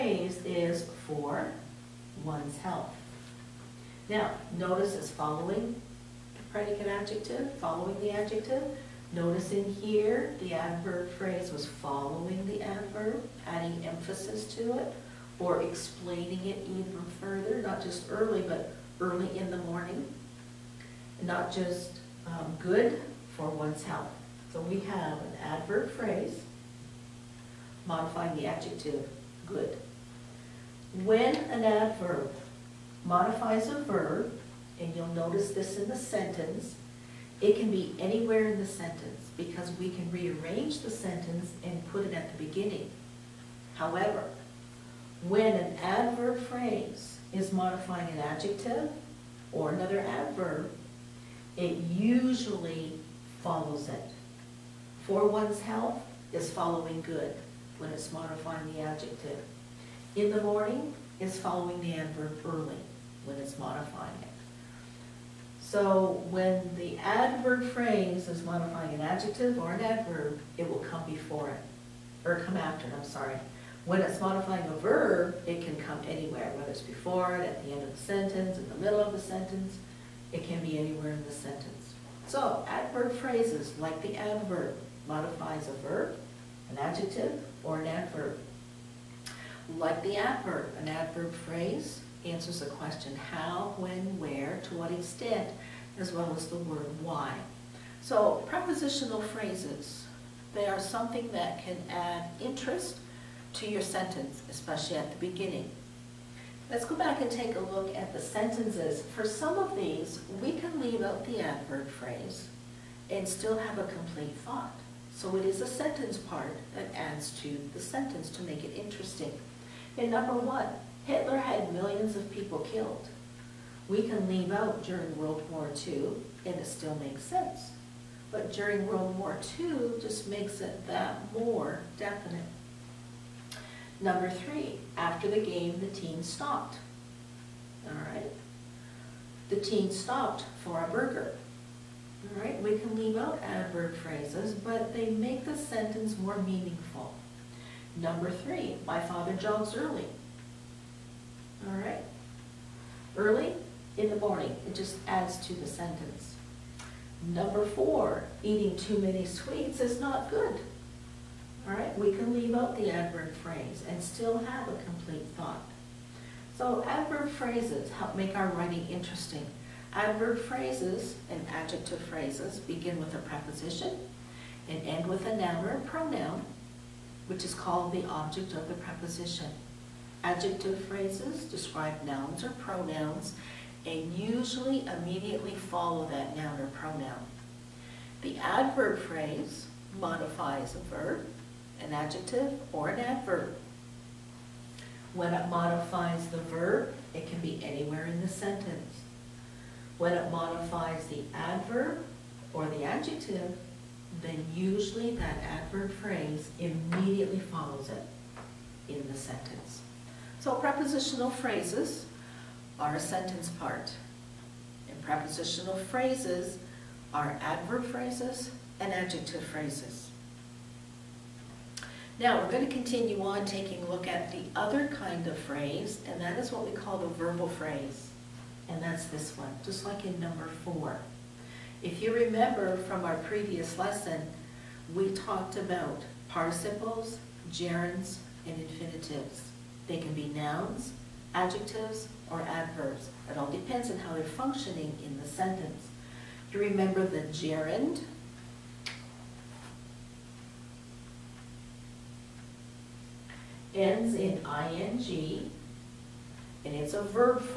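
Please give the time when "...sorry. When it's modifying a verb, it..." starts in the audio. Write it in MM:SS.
01:13.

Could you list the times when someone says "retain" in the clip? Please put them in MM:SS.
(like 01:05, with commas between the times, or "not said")
not said.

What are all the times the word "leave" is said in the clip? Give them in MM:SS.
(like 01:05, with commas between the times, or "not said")
01:50, 02:04, 02:22, 02:42.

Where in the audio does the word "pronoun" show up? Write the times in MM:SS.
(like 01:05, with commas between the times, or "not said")
02:55, 03:02, 03:06.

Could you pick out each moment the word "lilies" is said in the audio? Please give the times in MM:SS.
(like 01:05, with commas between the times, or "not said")
not said.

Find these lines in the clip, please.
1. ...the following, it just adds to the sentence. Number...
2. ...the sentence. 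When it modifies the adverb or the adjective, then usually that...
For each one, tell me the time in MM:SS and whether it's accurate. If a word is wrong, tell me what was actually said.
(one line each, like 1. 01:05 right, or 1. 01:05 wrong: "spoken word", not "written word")
1. 02:34 wrong: "morning", not "following"
2. 03:18 right.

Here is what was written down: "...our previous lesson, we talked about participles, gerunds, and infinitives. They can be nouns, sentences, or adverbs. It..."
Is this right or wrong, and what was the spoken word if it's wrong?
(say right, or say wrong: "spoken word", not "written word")
wrong: "adjectives", not "sentences".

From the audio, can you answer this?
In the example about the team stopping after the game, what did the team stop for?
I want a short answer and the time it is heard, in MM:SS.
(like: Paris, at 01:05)
a burger, at 02:20.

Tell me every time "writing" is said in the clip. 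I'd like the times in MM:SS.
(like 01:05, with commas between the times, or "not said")
02:48.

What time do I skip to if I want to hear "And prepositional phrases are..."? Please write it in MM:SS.
03:34.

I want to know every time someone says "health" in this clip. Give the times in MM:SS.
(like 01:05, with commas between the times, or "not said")
00:02, 00:23, 00:55.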